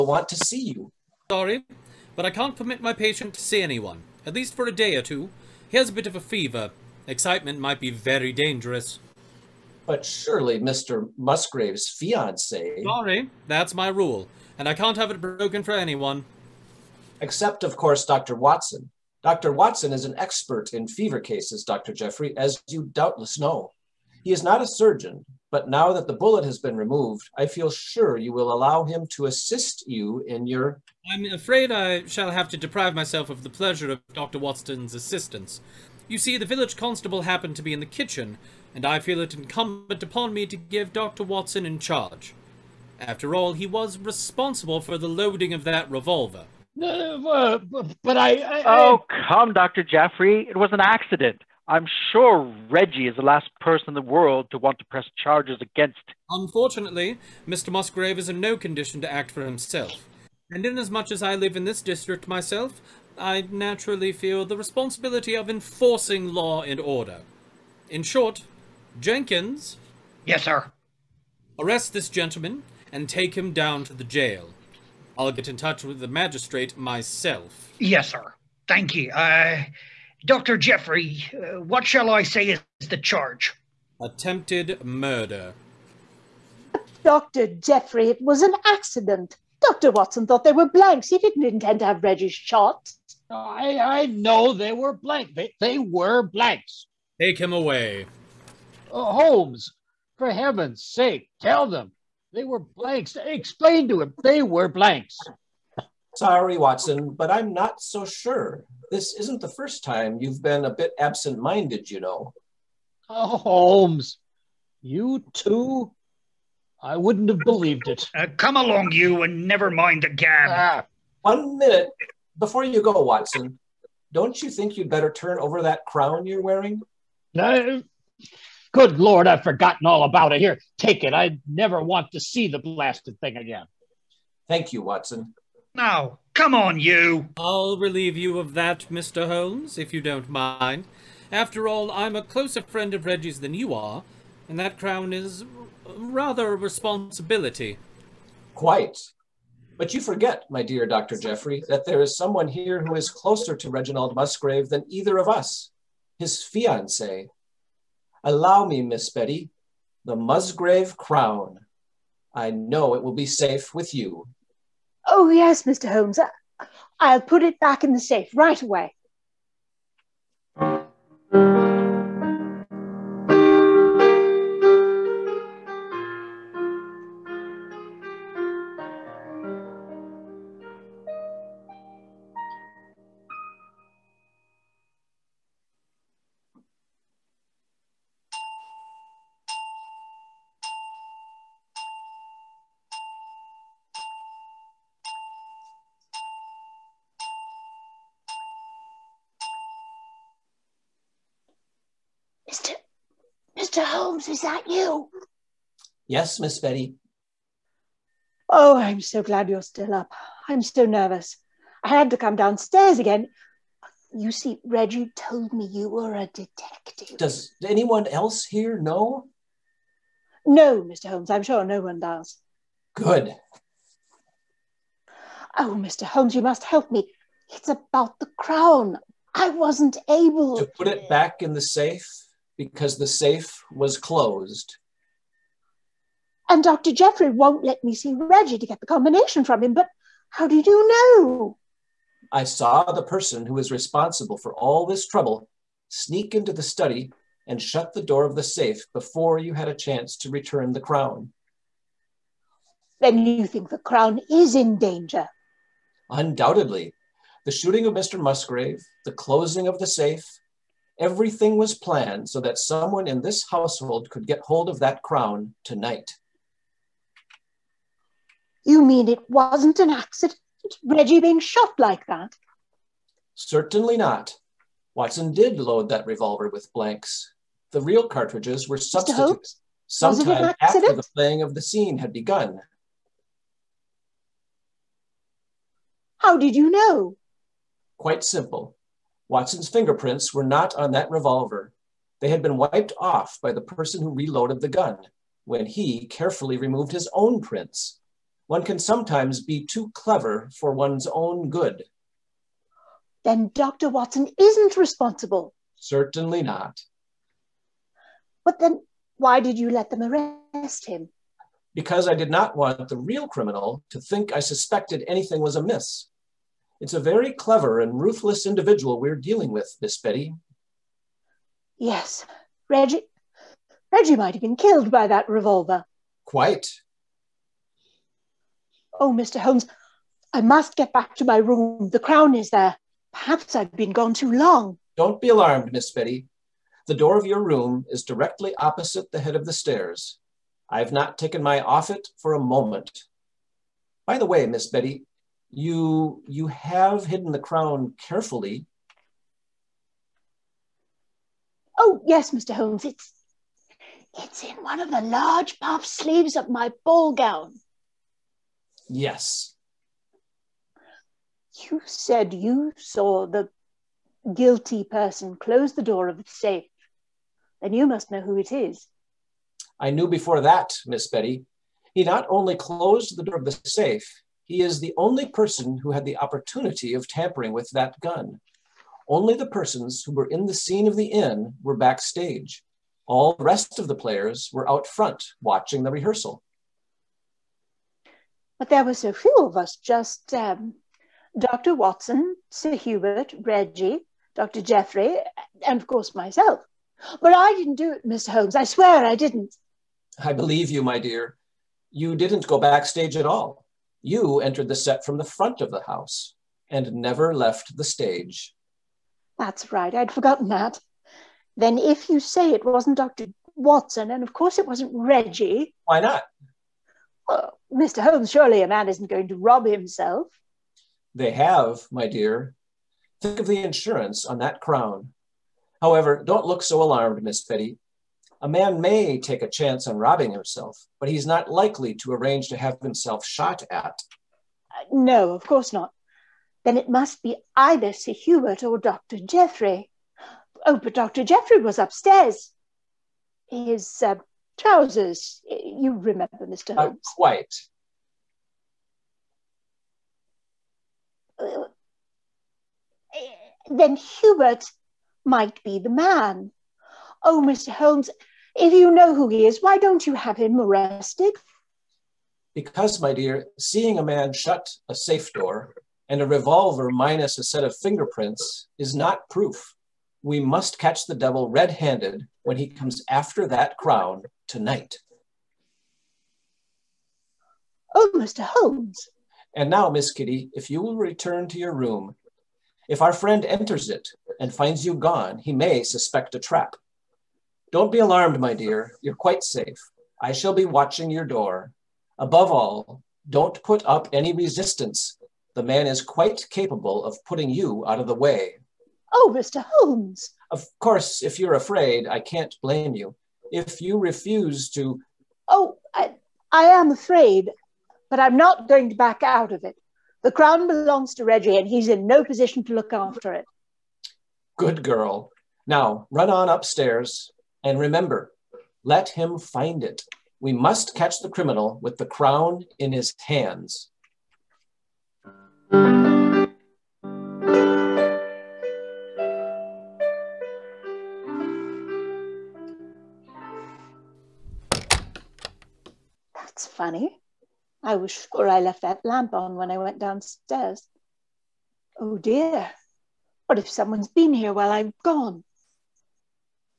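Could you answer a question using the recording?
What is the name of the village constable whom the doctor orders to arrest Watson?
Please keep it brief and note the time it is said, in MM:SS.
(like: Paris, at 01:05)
Jenkins, at 01:09.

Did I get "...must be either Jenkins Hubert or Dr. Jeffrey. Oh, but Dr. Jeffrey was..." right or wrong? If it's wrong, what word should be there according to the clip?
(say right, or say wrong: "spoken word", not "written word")
wrong: "Sir", not "Jenkins".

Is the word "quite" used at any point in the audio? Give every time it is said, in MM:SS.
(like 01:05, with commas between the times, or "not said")
02:28, 04:47, 05:26, 07:27, 08:09, 08:16.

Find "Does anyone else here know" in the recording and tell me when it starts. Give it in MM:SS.
03:37.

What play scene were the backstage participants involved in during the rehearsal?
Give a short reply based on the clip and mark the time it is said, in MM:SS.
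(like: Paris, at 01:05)
The scene of the inn, at 06:20.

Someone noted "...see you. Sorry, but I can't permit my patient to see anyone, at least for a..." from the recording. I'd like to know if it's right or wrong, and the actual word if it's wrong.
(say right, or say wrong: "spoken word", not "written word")
right.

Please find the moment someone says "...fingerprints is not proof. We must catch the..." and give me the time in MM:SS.
07:47.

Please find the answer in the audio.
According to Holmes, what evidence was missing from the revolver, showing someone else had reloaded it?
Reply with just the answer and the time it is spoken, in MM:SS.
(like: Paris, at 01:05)
Watson's fingerprints, at 04:49.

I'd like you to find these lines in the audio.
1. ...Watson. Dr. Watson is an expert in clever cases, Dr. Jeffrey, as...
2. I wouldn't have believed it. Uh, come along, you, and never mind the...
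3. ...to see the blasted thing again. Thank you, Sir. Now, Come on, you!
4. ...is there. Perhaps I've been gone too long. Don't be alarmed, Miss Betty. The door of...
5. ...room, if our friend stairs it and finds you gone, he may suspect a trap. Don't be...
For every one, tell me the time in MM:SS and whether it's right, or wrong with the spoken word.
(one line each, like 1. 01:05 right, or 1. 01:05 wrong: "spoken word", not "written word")
1. 00:18 wrong: "fever", not "clever"
2. 01:56 right
3. 02:12 wrong: "Watson", not "Sir"
4. 05:32 right
5. 08:01 wrong: "enters", not "stairs".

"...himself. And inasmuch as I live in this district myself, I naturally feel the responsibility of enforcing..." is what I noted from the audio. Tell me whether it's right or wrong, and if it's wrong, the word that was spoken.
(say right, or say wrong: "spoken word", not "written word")
right.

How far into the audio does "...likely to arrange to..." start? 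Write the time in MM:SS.
07:11.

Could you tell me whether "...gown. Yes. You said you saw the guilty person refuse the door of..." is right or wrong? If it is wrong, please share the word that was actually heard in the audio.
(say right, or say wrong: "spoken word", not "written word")
wrong: "close", not "refuse".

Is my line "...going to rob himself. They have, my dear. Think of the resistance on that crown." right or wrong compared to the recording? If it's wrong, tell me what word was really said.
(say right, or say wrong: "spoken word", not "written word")
wrong: "insurance", not "resistance".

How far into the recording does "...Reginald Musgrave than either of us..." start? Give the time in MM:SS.
02:33.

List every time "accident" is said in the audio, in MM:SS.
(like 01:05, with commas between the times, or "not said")
00:50, 01:28, 04:29.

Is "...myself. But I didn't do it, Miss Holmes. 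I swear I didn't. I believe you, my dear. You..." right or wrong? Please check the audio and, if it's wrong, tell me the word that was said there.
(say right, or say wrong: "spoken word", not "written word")
right.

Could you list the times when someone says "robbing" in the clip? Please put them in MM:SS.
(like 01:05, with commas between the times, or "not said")
07:09.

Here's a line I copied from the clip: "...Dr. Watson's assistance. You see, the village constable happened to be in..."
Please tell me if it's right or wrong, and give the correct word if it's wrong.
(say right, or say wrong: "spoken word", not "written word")
right.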